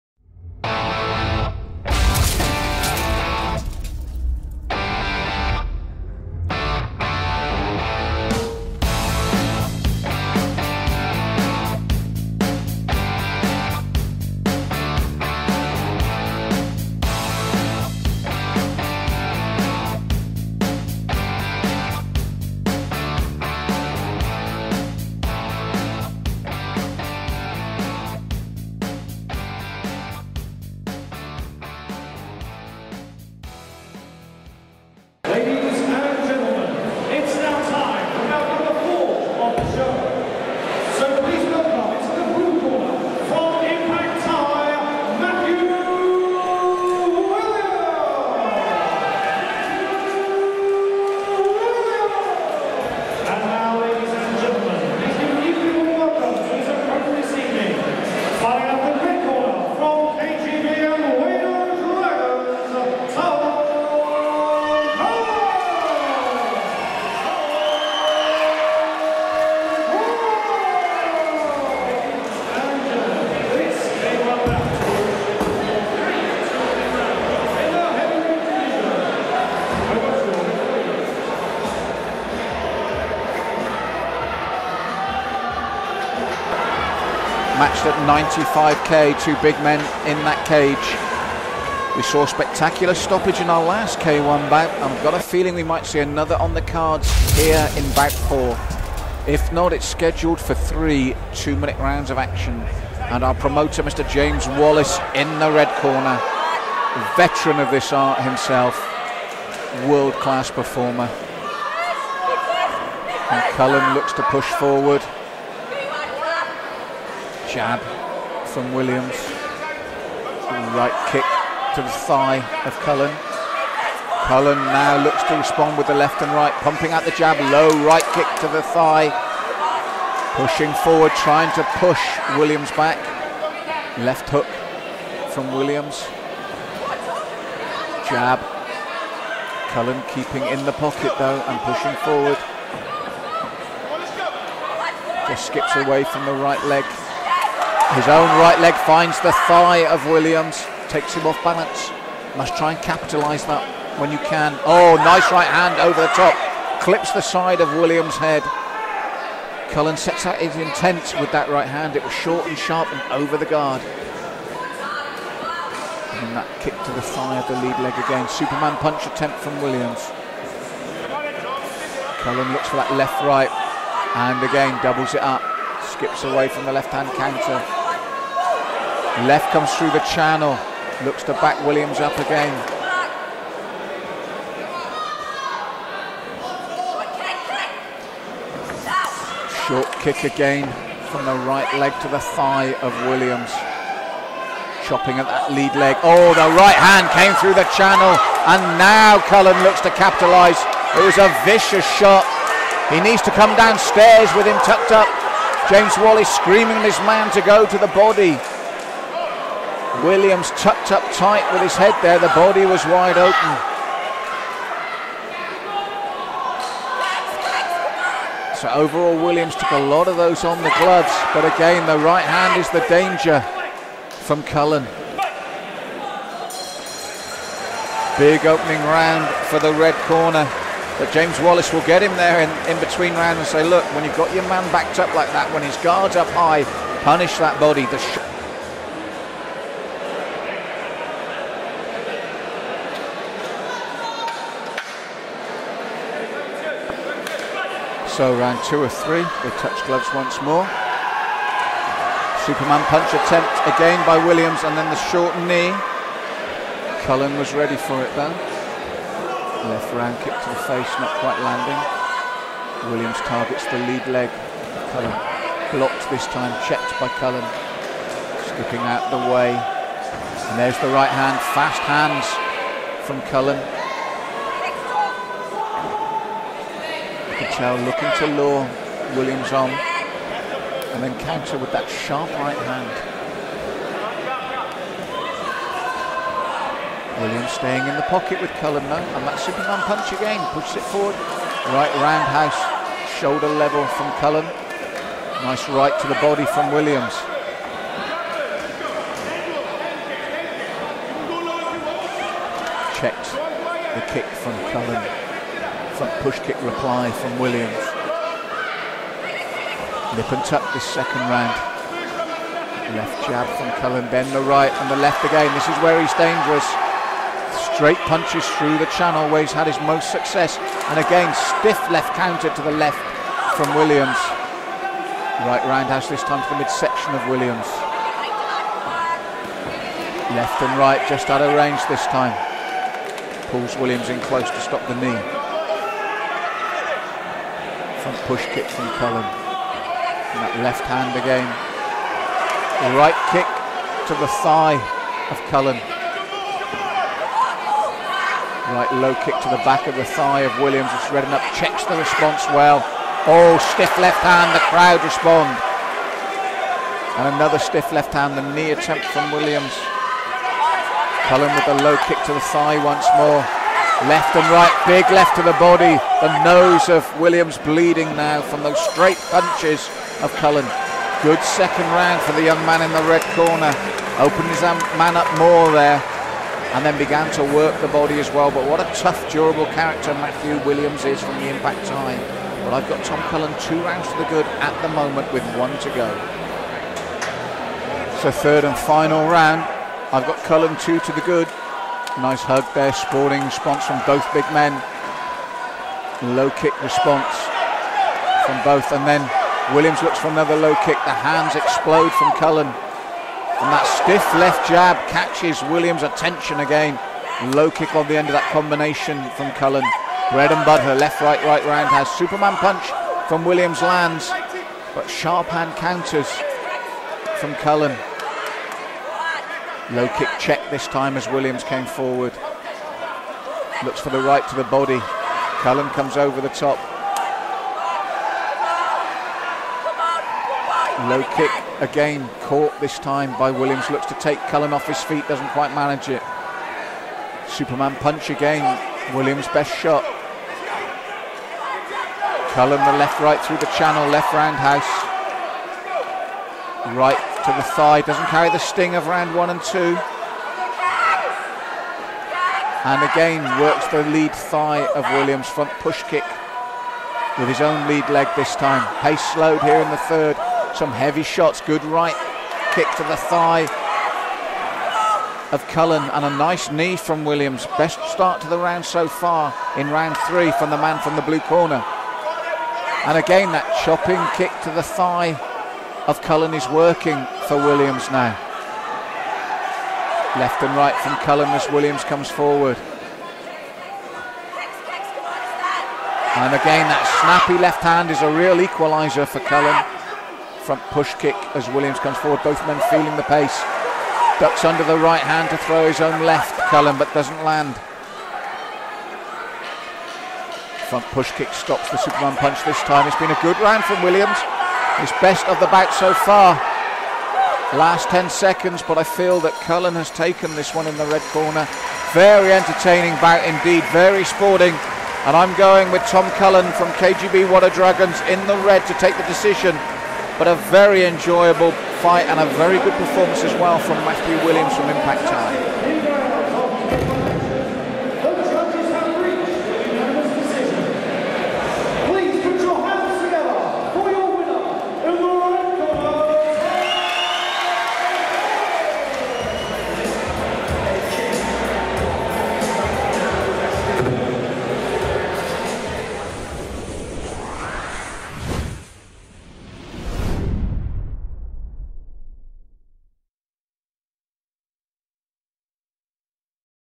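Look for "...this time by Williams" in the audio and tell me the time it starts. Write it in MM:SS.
07:12.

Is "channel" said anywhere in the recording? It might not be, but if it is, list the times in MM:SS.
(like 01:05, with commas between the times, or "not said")
02:59, 03:17, 05:18, 07:23.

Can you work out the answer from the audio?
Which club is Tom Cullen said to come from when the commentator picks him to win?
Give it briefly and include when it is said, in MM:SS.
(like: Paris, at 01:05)
KGB Water Dragons, at 08:37.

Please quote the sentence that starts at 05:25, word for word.
Right roundhouse this time to the midsection of Williams.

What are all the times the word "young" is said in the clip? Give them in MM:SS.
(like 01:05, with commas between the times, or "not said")
06:12.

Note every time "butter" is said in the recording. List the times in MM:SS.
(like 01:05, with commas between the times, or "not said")
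06:50.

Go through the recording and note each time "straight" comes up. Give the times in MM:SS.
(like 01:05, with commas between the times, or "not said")
05:17, 06:08.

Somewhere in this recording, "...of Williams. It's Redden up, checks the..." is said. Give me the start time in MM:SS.
05:50.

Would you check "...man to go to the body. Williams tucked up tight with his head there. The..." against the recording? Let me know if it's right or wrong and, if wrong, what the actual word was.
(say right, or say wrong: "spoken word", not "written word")
right.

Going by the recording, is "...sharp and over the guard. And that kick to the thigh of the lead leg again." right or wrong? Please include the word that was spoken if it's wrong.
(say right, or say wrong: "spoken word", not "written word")
right.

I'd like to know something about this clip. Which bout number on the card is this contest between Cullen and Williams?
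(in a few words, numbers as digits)
4.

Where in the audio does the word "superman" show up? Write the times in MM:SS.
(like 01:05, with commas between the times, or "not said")
02:48, 04:12, 04:49, 06:52, 07:17, 08:21.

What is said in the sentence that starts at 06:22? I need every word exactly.
But I've got Tom Cullen two rounds to the good at the moment with one to go.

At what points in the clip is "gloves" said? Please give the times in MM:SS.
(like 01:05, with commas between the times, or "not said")
03:40, 04:09.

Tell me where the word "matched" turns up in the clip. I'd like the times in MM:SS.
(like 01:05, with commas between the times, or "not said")
01:27.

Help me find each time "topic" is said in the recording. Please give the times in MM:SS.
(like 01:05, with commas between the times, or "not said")
not said.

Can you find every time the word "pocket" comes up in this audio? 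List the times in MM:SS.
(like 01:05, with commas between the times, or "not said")
02:20, 04:48.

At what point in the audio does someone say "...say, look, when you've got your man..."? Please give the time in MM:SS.
03:53.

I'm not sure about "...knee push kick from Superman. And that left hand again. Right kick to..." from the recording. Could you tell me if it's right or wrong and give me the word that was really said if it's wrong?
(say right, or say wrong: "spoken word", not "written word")
wrong: "Cullen", not "Superman".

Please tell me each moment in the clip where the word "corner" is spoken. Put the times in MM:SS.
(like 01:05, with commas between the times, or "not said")
01:45, 03:50, 06:13, 07:51, 08:31.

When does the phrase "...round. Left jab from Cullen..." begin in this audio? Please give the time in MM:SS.
05:11.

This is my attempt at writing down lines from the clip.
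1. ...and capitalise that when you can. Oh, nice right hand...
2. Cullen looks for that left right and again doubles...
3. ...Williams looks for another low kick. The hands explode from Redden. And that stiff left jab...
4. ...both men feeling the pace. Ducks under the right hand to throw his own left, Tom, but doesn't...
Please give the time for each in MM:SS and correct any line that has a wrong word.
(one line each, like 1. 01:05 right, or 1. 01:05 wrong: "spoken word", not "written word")
1. 02:32 right
2. 02:52 right
3. 06:39 wrong: "Cullen", not "Redden"
4. 08:12 wrong: "Cullen", not "Tom".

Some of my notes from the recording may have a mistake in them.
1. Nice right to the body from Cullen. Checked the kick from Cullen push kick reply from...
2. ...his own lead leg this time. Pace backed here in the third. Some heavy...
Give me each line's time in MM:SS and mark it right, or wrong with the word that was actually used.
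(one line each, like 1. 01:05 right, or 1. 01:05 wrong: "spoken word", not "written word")
1. 04:55 wrong: "Williams", not "Cullen"
2. 07:37 wrong: "slowed", not "backed".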